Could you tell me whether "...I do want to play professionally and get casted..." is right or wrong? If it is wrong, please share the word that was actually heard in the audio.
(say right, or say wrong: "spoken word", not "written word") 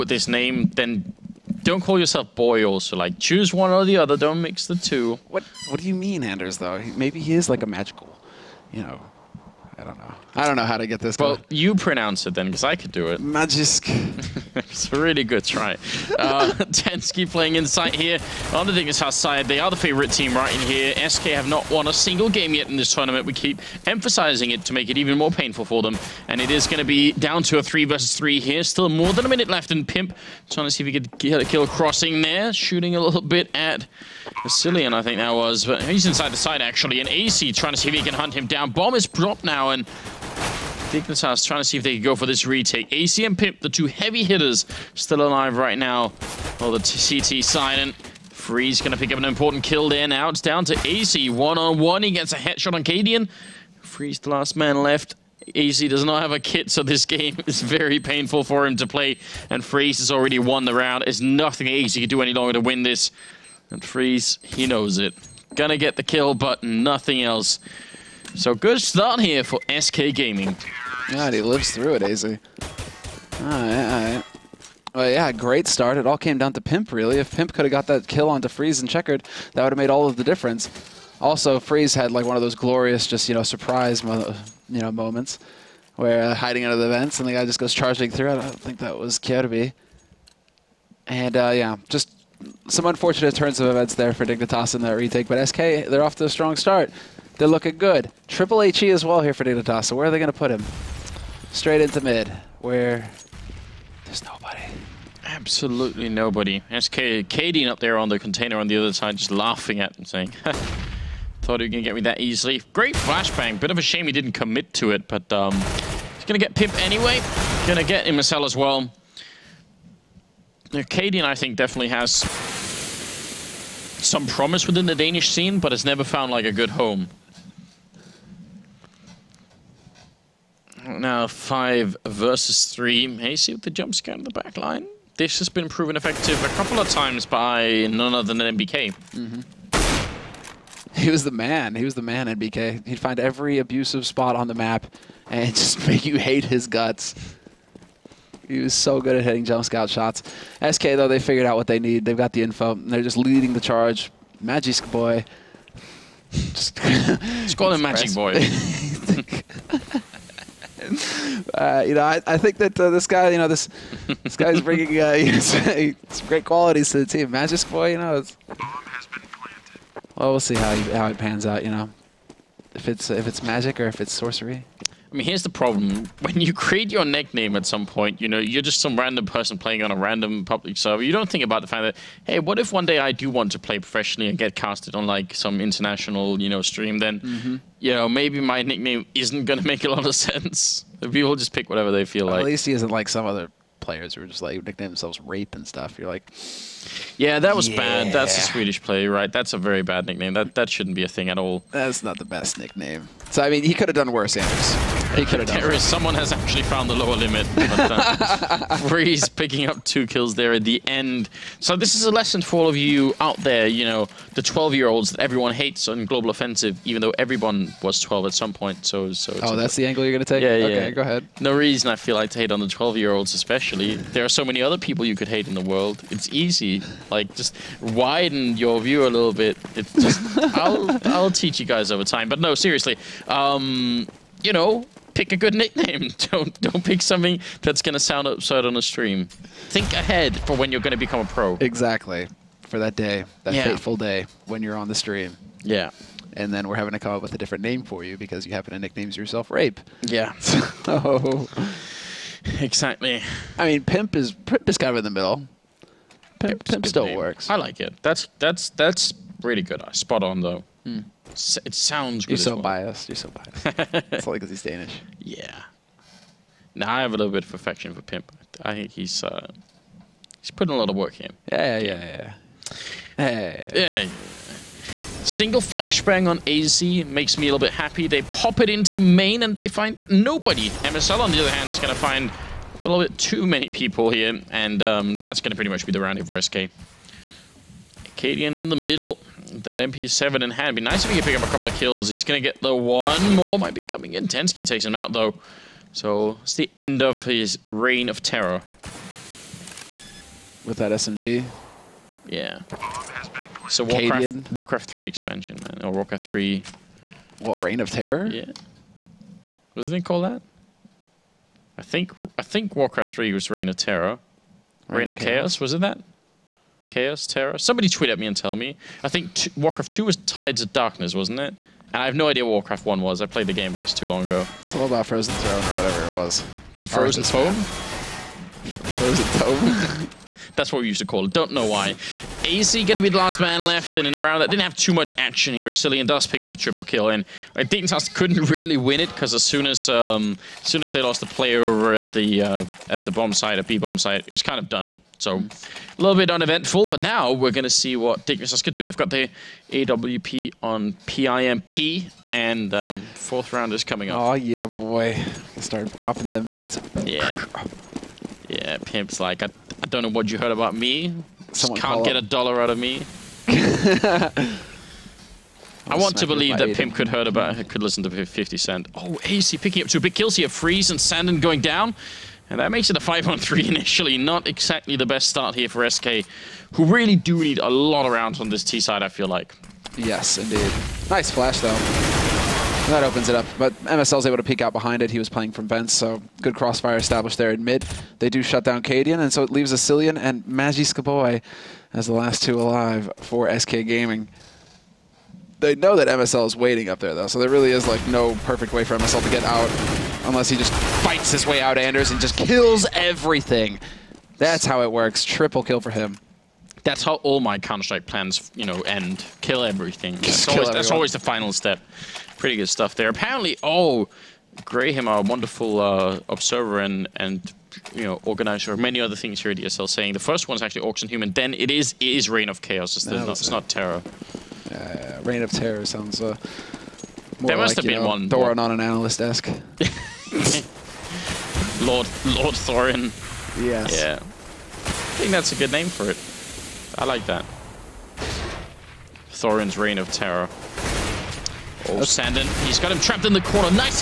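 right.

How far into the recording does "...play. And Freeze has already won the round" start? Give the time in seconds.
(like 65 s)
58 s.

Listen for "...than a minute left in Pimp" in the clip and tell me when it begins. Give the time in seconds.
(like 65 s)
29 s.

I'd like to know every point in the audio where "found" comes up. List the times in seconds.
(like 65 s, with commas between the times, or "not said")
126 s, 206 s.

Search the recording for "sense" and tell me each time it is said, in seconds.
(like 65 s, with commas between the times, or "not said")
190 s.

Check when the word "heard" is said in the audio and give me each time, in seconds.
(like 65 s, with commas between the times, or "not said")
360 s, 367 s.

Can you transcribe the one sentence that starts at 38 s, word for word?
Bomb is dropped now, and Dignitas trying to see if they could go for this retake.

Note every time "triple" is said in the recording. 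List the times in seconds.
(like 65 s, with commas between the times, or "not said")
98 s, 336 s, 405 s.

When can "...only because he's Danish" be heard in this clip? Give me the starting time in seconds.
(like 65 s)
264 s.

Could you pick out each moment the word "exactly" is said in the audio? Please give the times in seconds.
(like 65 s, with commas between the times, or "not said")
241 s, 252 s, 374 s.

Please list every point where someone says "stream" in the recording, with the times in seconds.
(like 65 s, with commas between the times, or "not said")
186 s, 238 s, 244 s.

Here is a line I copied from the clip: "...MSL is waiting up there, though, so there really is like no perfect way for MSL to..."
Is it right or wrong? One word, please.
right.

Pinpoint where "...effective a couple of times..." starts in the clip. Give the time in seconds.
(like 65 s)
135 s.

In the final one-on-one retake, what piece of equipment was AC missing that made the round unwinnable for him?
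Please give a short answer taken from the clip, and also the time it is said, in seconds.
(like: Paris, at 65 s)
a kit, at 55 s.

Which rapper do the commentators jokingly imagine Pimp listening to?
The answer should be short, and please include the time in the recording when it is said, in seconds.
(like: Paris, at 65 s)
50 Cent, at 368 s.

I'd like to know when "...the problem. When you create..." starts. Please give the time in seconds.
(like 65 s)
175 s.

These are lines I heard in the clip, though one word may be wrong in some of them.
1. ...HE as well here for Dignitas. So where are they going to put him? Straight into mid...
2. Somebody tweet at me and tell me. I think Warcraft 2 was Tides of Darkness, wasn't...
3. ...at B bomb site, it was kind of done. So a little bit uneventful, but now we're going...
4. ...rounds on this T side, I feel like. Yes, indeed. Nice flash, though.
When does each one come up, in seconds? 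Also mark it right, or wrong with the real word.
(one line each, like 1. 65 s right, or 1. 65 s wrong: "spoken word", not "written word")
1. 98 s right
2. 317 s right
3. 343 s right
4. 378 s right.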